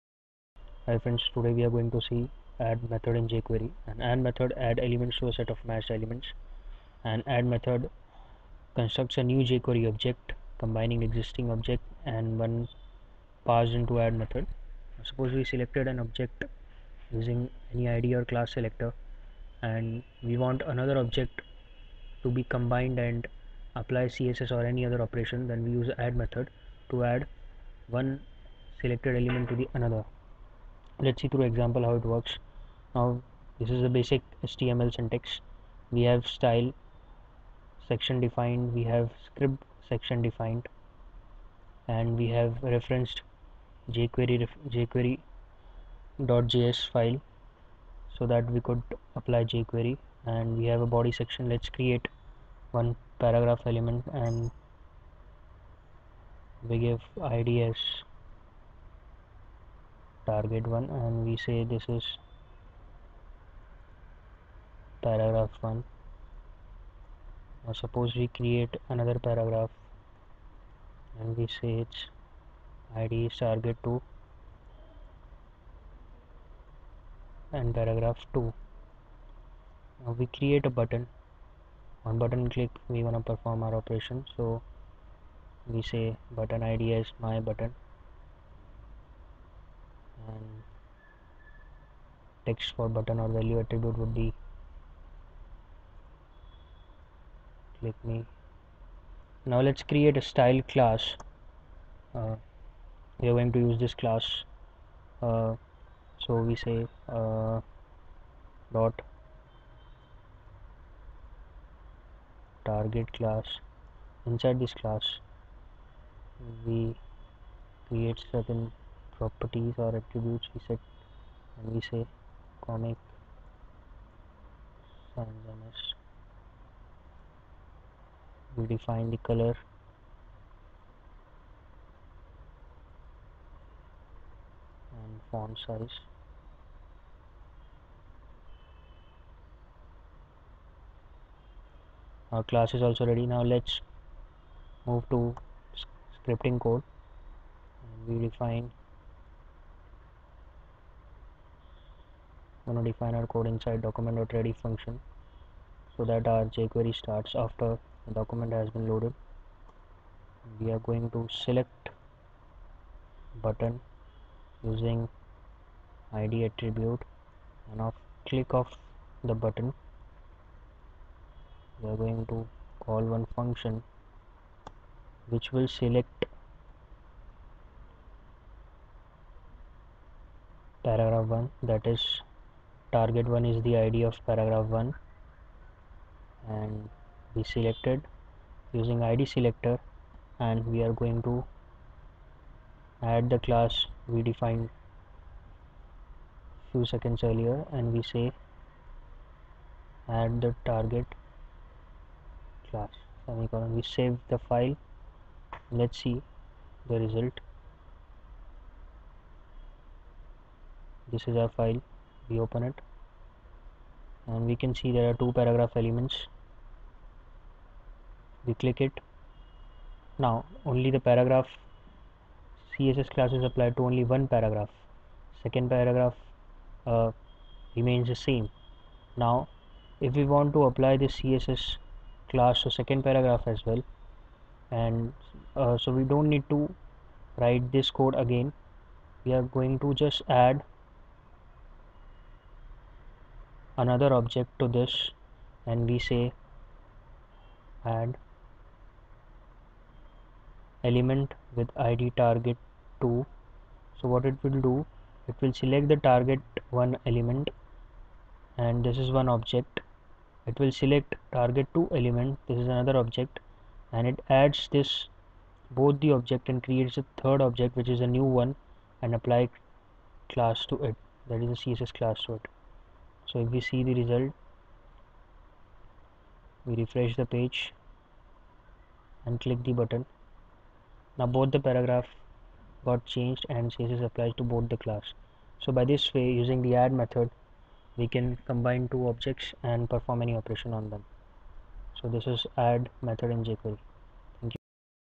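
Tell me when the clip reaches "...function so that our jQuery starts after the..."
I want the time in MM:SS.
02:34.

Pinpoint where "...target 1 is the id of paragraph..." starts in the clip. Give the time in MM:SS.
03:02.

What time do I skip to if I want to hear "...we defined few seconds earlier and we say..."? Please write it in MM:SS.
03:14.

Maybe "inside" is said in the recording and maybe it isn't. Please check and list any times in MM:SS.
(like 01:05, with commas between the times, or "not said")
01:54, 02:33.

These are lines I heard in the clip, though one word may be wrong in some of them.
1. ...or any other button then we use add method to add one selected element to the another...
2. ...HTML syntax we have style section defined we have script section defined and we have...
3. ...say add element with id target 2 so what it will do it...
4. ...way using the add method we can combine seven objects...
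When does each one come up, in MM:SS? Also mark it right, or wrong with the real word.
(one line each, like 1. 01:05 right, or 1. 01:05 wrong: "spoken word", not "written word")
1. 00:24 wrong: "operation", not "button"
2. 00:34 right
3. 04:05 right
4. 04:46 wrong: "two", not "seven".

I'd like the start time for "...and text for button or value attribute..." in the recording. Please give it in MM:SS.
01:30.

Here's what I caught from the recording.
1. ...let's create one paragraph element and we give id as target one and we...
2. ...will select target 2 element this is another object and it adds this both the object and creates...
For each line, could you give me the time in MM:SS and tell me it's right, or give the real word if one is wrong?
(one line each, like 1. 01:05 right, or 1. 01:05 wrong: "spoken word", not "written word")
1. 00:51 right
2. 04:20 right.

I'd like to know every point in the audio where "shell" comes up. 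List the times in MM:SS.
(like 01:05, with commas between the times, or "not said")
not said.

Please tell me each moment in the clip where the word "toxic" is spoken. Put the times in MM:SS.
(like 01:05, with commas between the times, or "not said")
not said.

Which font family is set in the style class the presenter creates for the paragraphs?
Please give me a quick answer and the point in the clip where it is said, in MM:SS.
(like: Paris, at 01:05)
Comic Sans, at 02:02.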